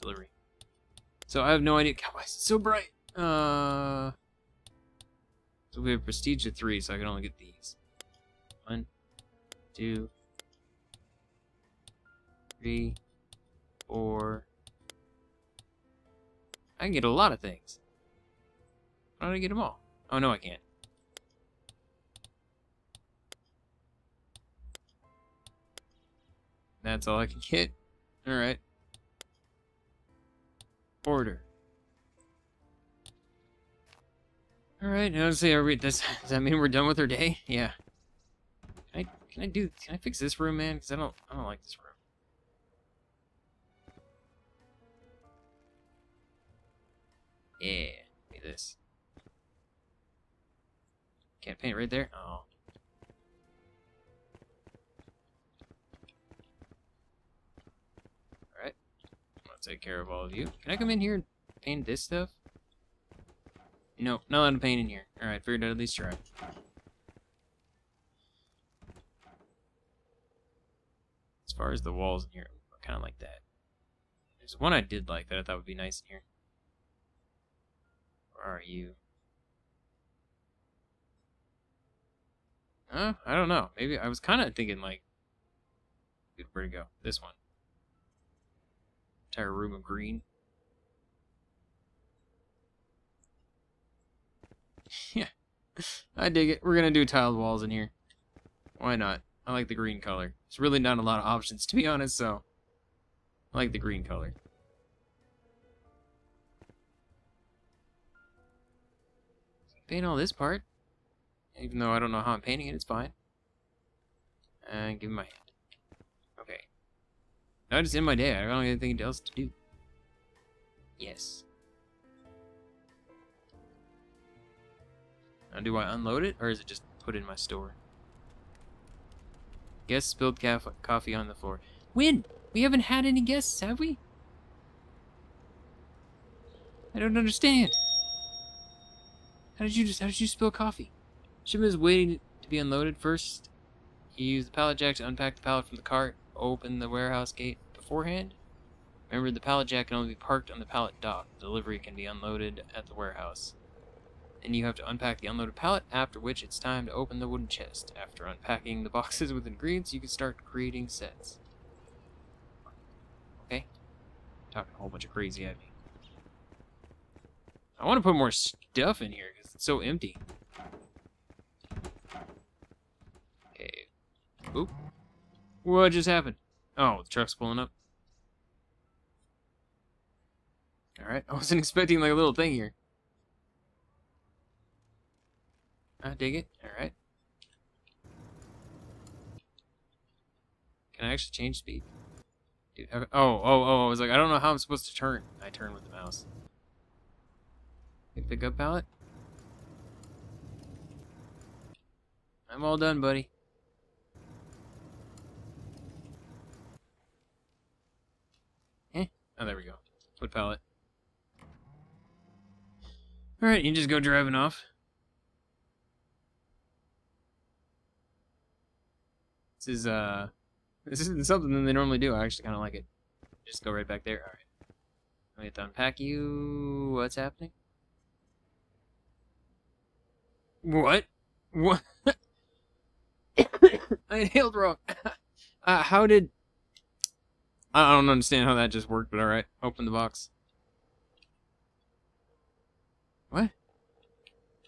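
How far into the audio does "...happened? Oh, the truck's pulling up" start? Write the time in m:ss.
2:56.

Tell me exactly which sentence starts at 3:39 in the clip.
This is, uh, this isn't something that they normally do.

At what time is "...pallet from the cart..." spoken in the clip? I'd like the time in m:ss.
2:25.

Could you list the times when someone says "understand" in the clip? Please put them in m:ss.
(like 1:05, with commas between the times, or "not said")
2:17, 3:58.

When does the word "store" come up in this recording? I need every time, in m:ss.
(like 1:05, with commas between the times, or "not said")
2:07.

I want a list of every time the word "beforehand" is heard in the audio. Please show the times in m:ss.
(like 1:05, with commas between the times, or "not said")
2:27.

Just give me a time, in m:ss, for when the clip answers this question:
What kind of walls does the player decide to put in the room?
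1:37.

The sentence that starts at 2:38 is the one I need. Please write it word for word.
After unpacking the boxes with ingredients, you can start creating sets.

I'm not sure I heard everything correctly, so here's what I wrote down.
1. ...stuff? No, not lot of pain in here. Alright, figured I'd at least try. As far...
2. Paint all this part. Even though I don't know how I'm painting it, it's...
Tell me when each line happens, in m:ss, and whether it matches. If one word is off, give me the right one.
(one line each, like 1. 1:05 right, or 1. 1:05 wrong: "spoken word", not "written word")
1. 1:02 right
2. 1:49 right.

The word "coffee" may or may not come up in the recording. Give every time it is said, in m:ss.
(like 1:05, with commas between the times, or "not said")
2:10, 2:20.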